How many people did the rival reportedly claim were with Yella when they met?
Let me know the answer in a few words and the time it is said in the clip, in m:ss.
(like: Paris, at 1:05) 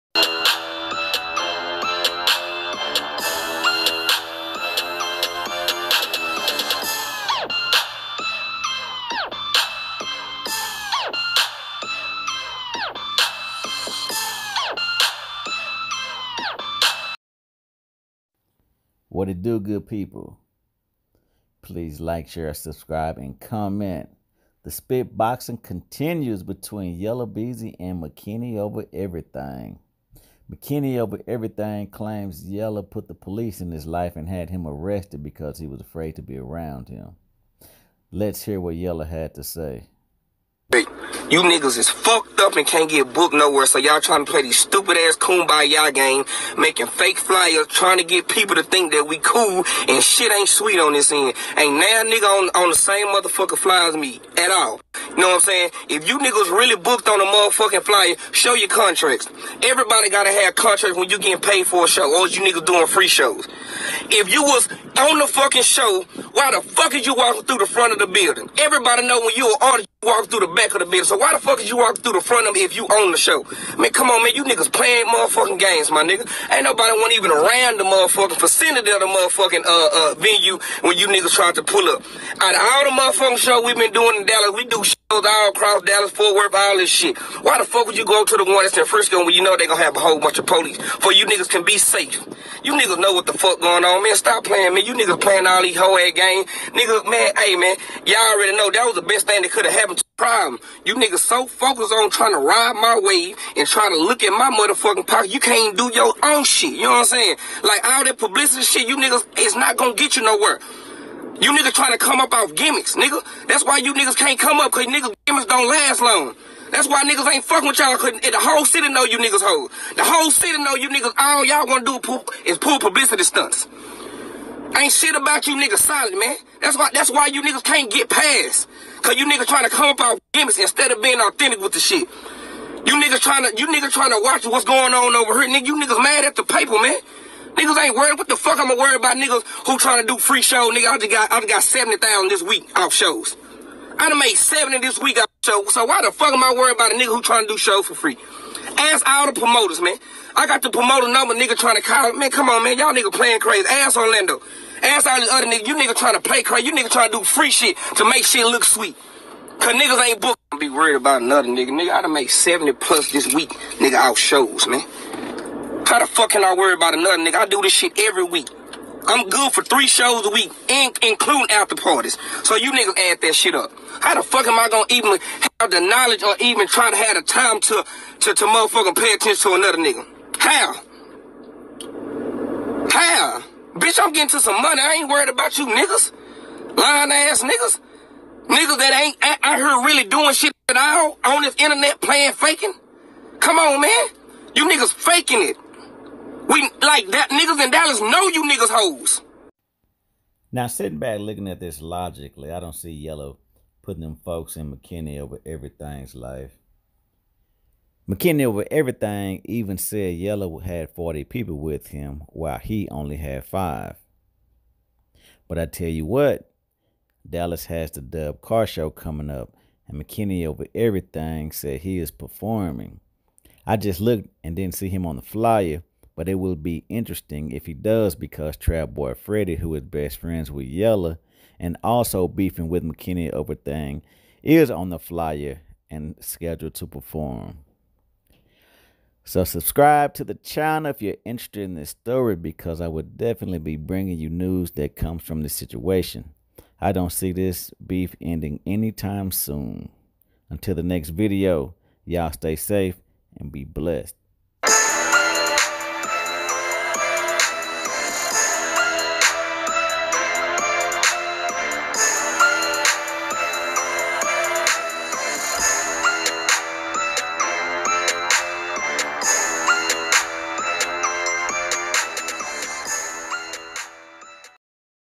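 40, at 3:30.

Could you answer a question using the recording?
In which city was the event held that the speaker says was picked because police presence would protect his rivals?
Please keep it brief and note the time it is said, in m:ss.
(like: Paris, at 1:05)
Frisco, at 1:28.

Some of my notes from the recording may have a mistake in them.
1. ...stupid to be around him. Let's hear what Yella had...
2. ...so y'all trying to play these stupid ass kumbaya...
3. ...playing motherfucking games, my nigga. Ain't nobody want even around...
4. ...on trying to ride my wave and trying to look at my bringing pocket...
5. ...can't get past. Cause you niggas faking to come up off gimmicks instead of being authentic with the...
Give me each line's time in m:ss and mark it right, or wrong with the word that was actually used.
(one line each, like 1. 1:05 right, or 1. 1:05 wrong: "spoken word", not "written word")
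1. 0:35 wrong: "afraid", not "stupid"
2. 0:43 right
3. 1:14 right
4. 1:41 wrong: "motherfucking", not "bringing"
5. 2:07 wrong: "trying", not "faking".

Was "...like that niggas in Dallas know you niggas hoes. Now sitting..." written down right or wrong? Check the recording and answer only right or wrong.
right.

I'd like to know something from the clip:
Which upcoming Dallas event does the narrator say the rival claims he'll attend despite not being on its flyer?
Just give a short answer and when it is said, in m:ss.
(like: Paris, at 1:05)
Dub Car Show, at 3:38.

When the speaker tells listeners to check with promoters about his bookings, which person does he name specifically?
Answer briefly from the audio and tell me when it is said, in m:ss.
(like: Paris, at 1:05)
Orlando, at 2:33.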